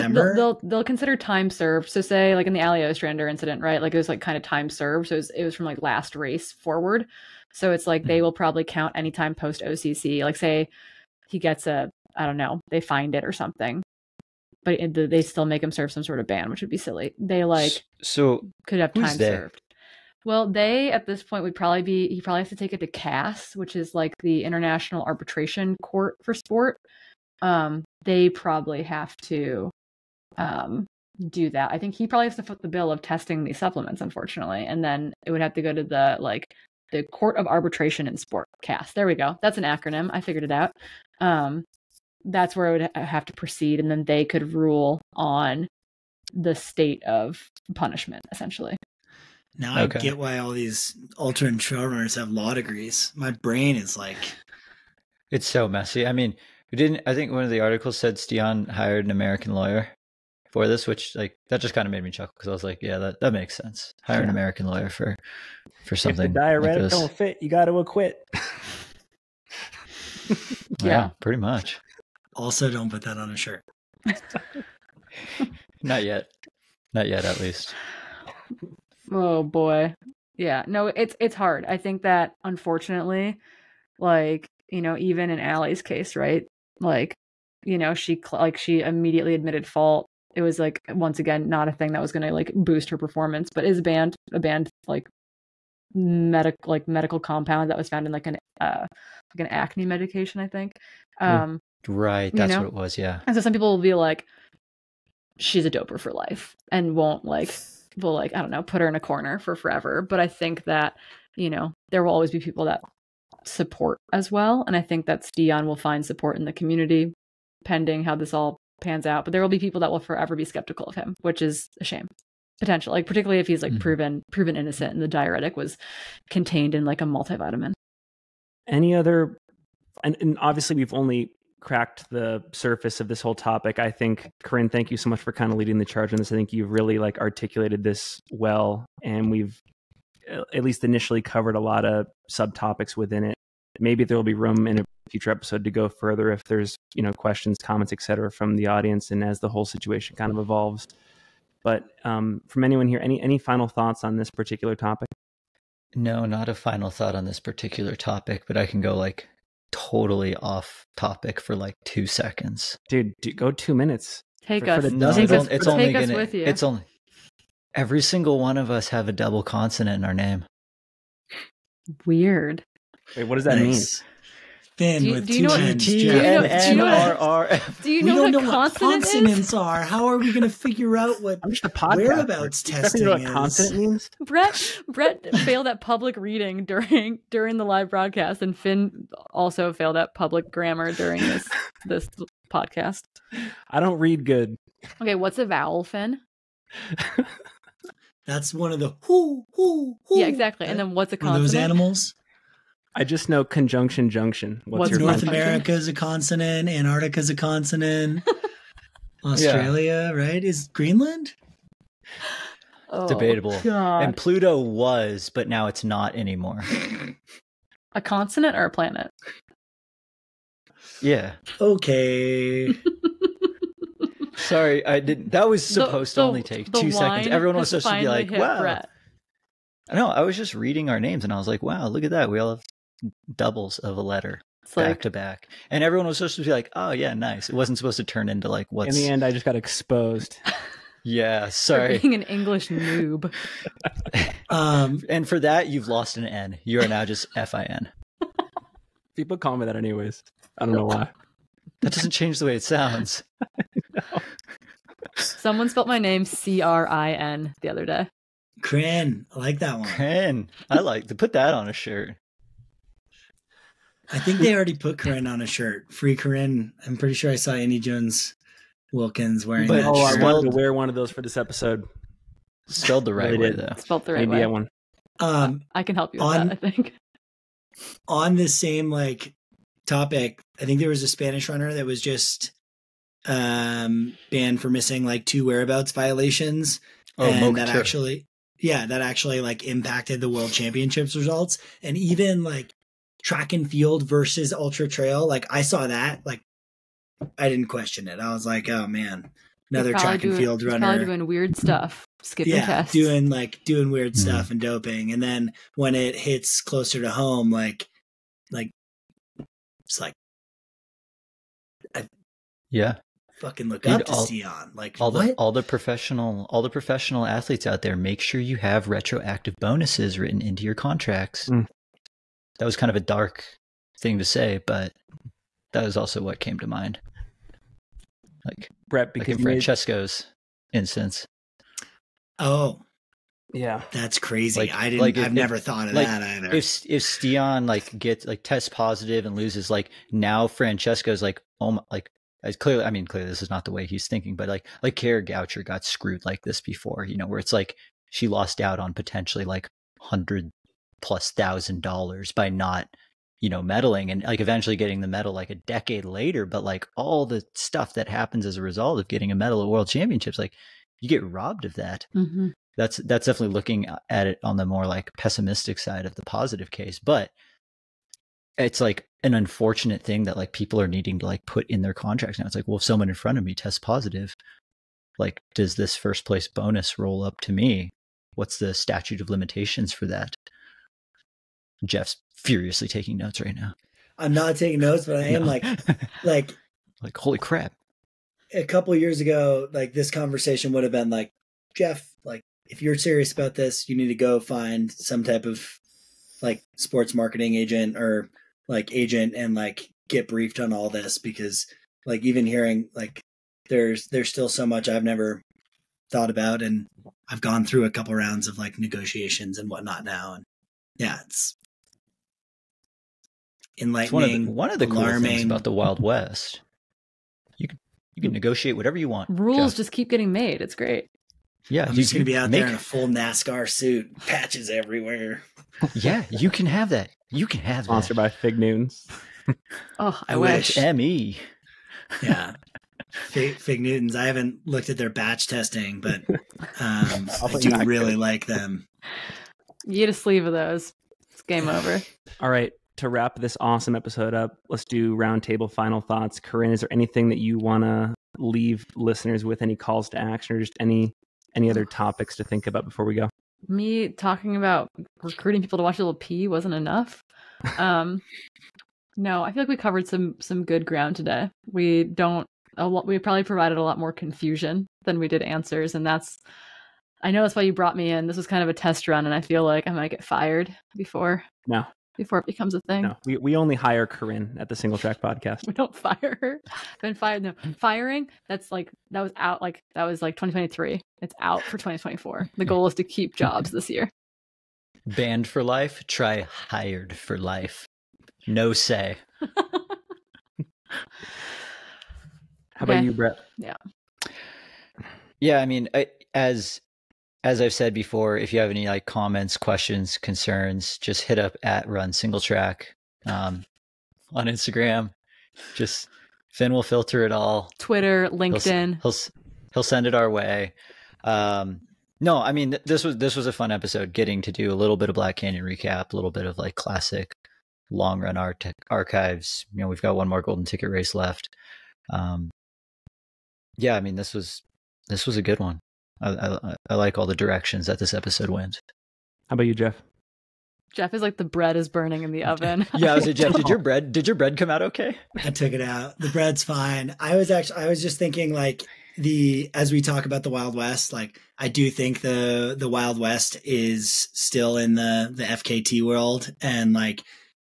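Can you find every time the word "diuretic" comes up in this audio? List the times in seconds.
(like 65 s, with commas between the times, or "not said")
66 s, 125 s.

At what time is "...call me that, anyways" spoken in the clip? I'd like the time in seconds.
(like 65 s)
249 s.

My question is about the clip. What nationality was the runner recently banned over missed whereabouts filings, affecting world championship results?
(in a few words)
Spanish.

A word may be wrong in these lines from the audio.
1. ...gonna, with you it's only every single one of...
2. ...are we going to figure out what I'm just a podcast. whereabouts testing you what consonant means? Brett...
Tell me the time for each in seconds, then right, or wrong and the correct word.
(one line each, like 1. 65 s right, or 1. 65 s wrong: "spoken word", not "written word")
1. 165 s right
2. 180 s right.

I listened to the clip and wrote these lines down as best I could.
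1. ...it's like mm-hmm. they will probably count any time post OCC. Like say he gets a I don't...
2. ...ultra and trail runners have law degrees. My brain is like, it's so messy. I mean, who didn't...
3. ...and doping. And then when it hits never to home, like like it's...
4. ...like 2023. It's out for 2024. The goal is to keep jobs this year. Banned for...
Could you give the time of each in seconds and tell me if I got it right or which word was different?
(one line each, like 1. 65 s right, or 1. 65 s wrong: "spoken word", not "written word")
1. 7 s right
2. 51 s right
3. 304 s wrong: "closer", not "never"
4. 480 s right.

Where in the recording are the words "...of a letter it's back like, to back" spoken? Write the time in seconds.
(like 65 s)
233 s.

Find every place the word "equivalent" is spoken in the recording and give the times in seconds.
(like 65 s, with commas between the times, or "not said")
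not said.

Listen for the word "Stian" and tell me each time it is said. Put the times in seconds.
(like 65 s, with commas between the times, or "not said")
58 s, 115 s, 337 s.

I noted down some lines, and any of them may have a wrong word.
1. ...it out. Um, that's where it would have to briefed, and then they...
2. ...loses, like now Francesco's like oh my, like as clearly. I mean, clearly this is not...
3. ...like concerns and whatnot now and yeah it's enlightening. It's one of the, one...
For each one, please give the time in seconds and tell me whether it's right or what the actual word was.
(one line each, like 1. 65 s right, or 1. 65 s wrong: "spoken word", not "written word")
1. 40 s wrong: "proceed", not "briefed"
2. 339 s right
3. 408 s wrong: "negotiations", not "concerns".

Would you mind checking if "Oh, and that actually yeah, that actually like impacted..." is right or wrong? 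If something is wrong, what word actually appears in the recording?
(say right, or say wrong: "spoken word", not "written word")
right.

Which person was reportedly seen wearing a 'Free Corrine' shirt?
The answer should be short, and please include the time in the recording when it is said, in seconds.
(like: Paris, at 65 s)
Andy Jones Wilkins, at 267 s.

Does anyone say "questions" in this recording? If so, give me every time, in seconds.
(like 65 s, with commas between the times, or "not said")
147 s, 297 s, 499 s.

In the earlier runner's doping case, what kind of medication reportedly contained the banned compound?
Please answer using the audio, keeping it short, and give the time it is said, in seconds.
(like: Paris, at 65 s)
Acne medication, at 99 s.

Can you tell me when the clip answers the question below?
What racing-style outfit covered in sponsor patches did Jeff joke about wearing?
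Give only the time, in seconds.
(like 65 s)
423 s.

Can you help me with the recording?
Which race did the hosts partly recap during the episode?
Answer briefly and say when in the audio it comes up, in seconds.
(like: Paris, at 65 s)
Black Canyon, at 515 s.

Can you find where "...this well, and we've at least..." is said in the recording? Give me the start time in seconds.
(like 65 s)
137 s.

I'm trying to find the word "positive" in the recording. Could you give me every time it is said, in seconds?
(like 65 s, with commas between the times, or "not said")
338 s, 366 s, 373 s.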